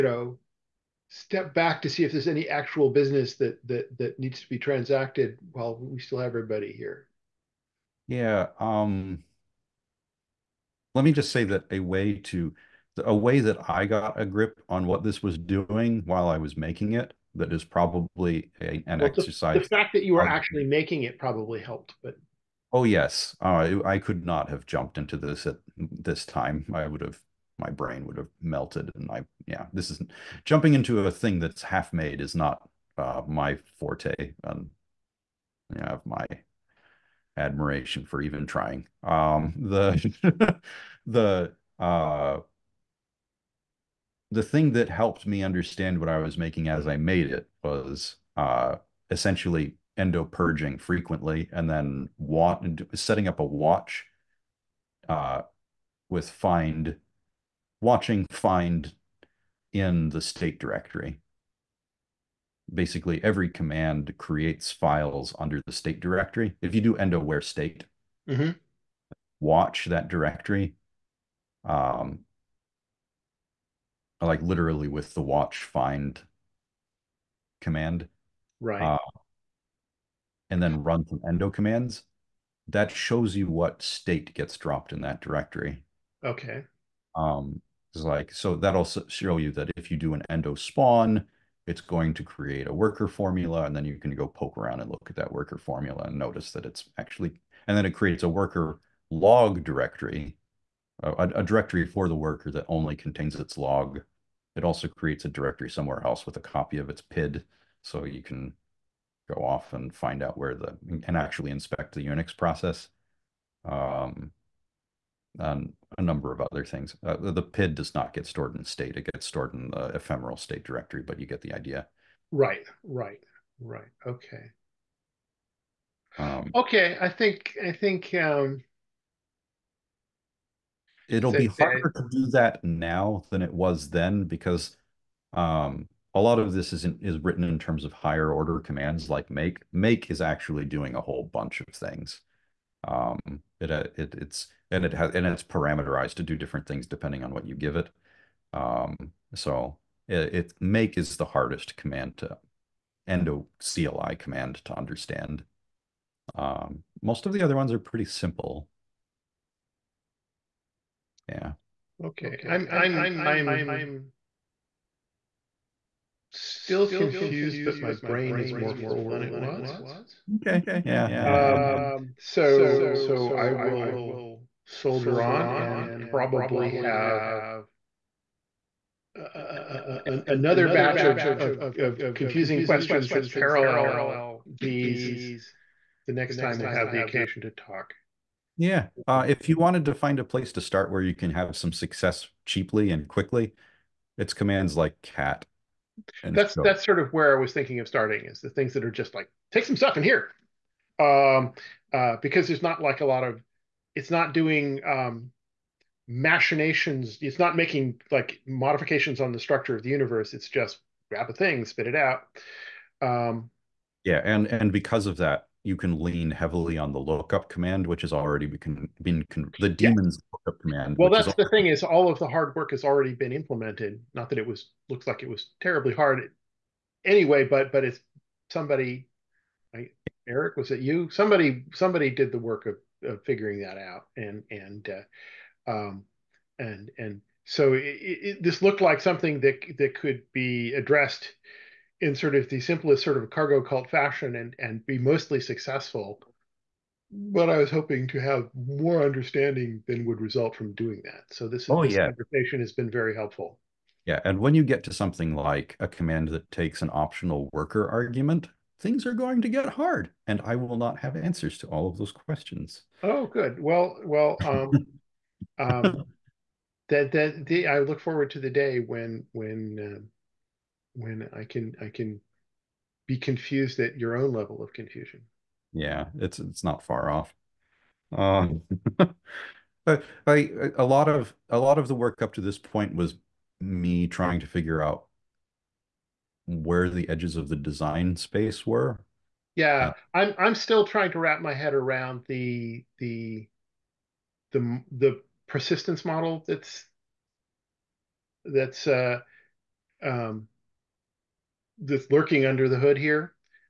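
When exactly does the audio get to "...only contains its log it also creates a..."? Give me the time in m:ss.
1:42.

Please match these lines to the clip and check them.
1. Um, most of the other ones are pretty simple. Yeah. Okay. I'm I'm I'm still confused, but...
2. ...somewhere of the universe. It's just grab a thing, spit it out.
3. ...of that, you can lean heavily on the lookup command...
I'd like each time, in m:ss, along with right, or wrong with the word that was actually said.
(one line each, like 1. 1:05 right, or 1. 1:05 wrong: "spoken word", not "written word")
1. 2:36 right
2. 3:29 wrong: "structure", not "somewhere"
3. 3:35 right.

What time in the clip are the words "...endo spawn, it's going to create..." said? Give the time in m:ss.
1:30.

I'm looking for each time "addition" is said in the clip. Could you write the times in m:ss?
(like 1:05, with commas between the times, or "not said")
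not said.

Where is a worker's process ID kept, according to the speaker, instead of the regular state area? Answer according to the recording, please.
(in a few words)
ephemeral state directory.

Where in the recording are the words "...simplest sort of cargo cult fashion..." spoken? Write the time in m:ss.
4:02.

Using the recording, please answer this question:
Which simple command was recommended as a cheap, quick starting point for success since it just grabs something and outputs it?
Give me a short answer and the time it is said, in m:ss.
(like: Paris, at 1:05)
cat, at 3:15.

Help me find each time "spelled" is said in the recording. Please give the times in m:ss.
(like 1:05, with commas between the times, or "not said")
not said.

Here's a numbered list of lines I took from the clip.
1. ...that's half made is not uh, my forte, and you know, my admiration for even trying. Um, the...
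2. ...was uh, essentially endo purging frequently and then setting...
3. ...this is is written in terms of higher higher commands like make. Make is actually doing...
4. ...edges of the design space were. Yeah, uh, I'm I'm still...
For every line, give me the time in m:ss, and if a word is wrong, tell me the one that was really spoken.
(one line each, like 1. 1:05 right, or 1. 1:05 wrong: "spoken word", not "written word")
1. 0:31 right
2. 0:47 right
3. 2:16 wrong: "order", not "higher"
4. 4:47 right.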